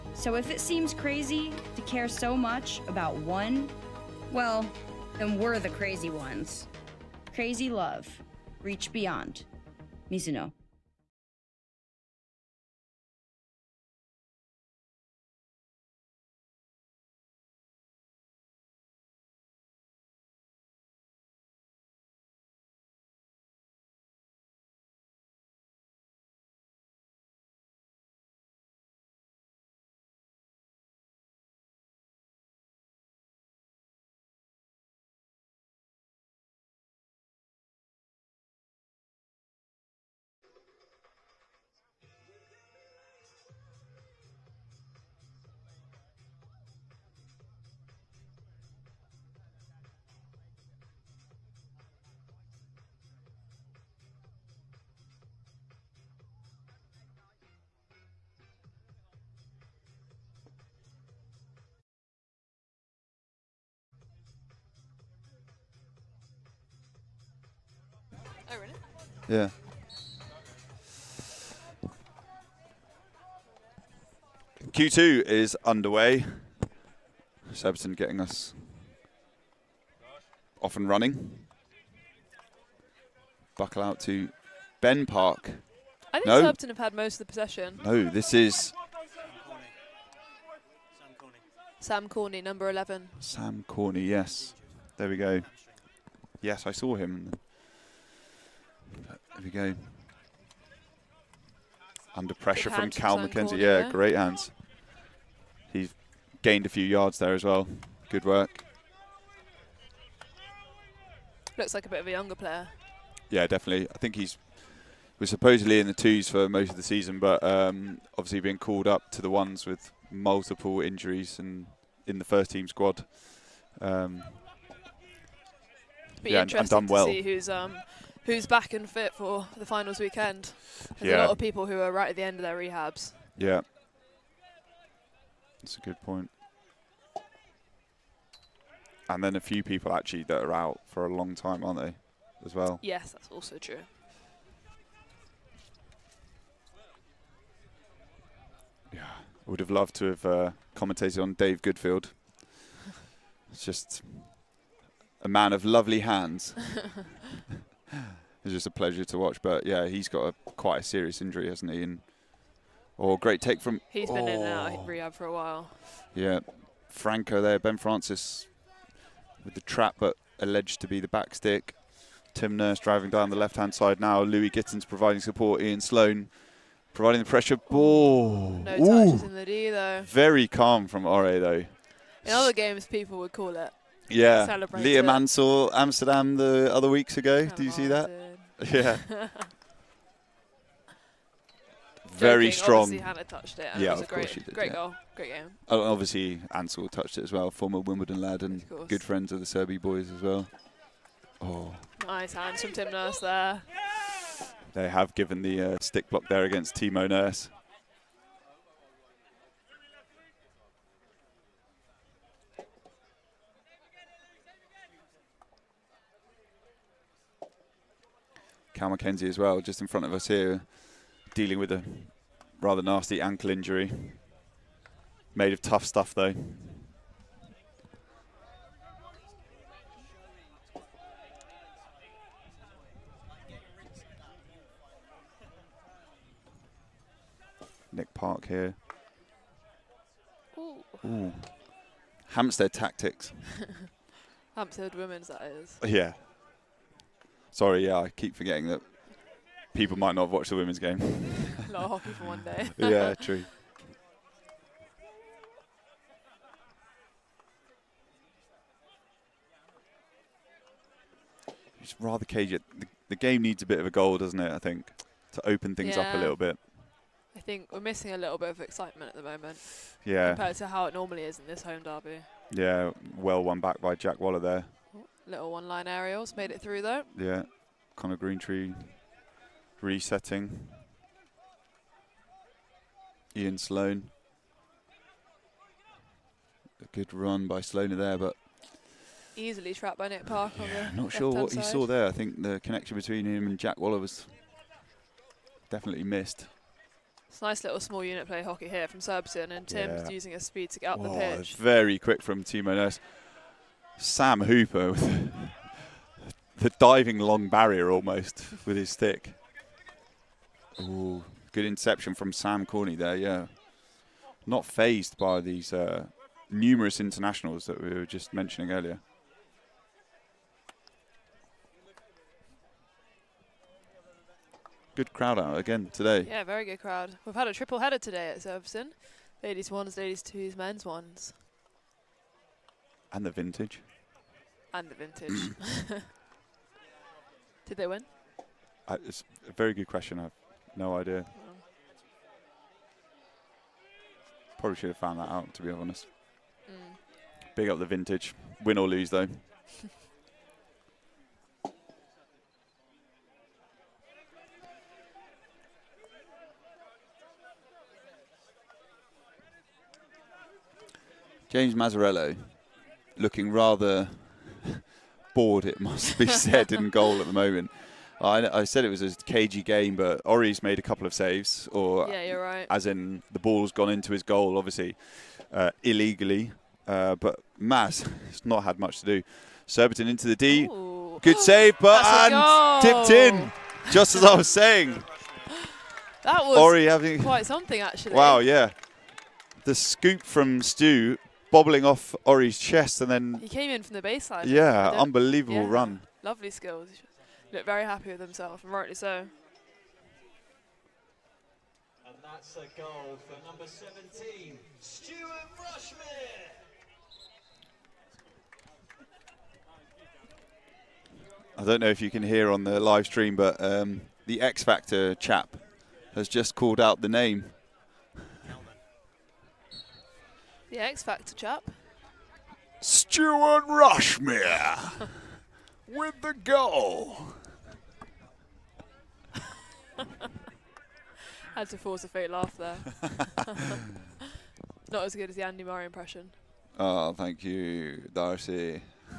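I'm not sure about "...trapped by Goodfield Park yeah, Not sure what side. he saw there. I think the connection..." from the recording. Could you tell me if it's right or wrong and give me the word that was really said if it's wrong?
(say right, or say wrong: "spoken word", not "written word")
wrong: "Nick", not "Goodfield".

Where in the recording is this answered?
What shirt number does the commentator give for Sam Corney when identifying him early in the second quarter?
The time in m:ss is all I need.
1:32.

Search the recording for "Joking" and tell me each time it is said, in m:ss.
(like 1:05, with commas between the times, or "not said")
3:12.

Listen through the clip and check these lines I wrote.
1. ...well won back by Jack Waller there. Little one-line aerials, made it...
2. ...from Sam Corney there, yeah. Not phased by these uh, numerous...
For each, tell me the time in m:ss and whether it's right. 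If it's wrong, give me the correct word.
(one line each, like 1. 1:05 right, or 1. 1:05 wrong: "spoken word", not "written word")
1. 4:33 right
2. 5:12 right.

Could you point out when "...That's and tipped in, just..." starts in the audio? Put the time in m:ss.
6:22.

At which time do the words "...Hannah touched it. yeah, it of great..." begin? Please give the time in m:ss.
3:12.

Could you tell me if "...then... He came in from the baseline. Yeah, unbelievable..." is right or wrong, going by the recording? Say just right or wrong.
right.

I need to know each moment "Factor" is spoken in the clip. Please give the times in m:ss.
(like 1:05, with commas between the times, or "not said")
6:54, 7:01.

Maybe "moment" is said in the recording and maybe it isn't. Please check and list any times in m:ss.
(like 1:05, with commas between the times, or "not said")
4:29, 6:07.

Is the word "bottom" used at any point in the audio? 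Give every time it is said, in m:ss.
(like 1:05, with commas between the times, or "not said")
not said.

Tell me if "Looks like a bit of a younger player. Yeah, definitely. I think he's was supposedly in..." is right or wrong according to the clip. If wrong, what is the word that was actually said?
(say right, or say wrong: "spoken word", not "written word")
right.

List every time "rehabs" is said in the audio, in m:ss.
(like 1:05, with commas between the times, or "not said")
2:12, 2:44.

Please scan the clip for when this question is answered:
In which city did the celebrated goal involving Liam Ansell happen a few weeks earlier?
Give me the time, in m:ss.
3:05.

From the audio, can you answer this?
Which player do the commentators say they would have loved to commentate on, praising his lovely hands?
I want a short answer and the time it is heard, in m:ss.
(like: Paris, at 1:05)
Dave Goodfield, at 2:31.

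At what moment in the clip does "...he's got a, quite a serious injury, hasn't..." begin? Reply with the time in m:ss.
2:39.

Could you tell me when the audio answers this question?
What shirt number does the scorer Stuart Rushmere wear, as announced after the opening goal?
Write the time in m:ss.
6:43.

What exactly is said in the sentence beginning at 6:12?
as in the ball's gone into his goal, obviously uh, illegally.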